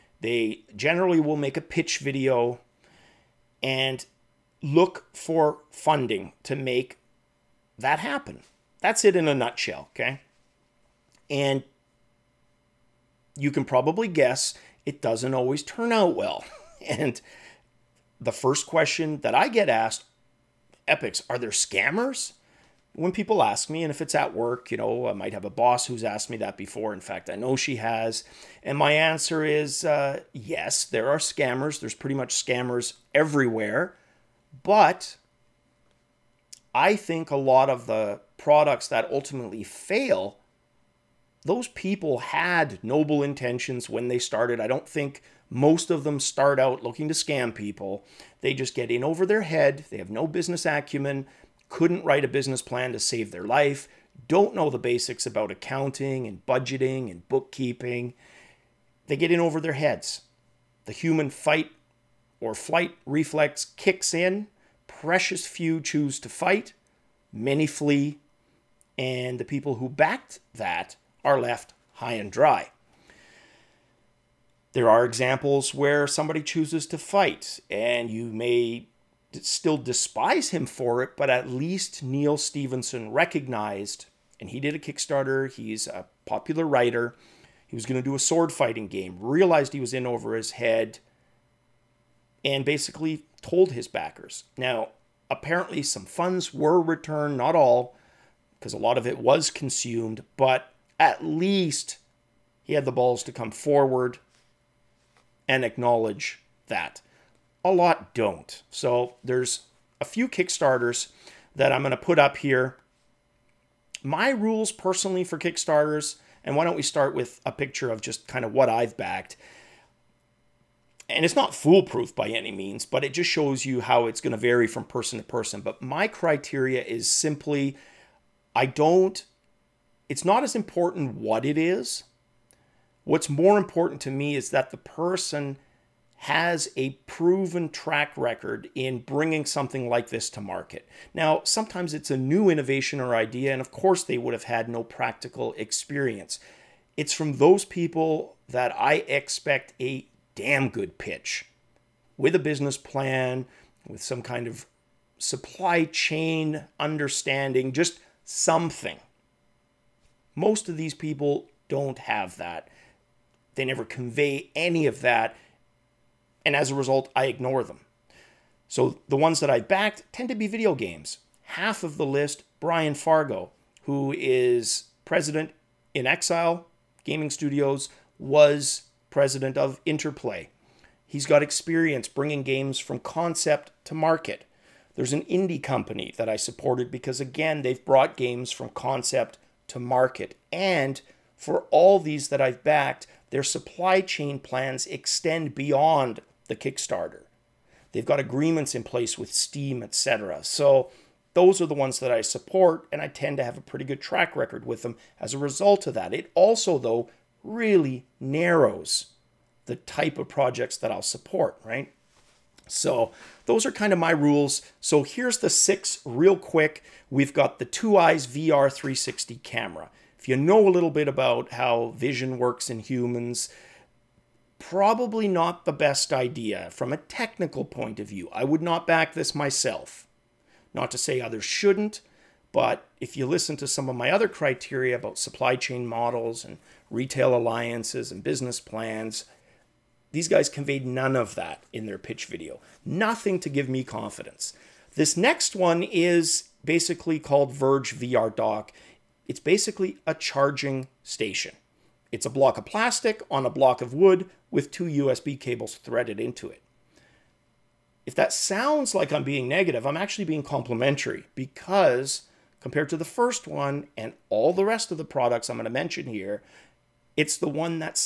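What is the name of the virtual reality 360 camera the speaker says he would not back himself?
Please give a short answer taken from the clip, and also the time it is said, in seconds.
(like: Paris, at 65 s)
Two Eyes VR 360 camera, at 217 s.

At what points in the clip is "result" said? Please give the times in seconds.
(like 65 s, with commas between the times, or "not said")
166 s, 205 s.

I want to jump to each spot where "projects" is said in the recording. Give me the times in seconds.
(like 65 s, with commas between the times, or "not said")
210 s.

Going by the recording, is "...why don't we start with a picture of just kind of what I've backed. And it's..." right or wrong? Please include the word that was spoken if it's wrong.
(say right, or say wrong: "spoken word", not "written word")
right.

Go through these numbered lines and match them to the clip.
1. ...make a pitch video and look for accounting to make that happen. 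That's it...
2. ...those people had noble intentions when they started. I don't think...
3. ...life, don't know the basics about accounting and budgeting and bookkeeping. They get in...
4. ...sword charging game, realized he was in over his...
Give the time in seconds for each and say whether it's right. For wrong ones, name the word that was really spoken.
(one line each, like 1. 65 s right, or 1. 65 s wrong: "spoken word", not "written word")
1. 1 s wrong: "funding", not "accounting"
2. 41 s right
3. 53 s right
4. 88 s wrong: "fighting", not "charging".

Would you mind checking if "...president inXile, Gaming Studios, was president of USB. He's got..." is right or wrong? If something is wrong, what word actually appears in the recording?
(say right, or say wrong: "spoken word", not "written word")
wrong: "Interplay", not "USB".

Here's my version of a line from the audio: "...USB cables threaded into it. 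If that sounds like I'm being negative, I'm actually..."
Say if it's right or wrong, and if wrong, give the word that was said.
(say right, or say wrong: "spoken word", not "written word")
right.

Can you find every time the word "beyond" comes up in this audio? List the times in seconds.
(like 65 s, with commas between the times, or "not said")
195 s.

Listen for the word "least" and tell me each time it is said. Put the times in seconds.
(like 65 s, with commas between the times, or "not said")
81 s, 101 s.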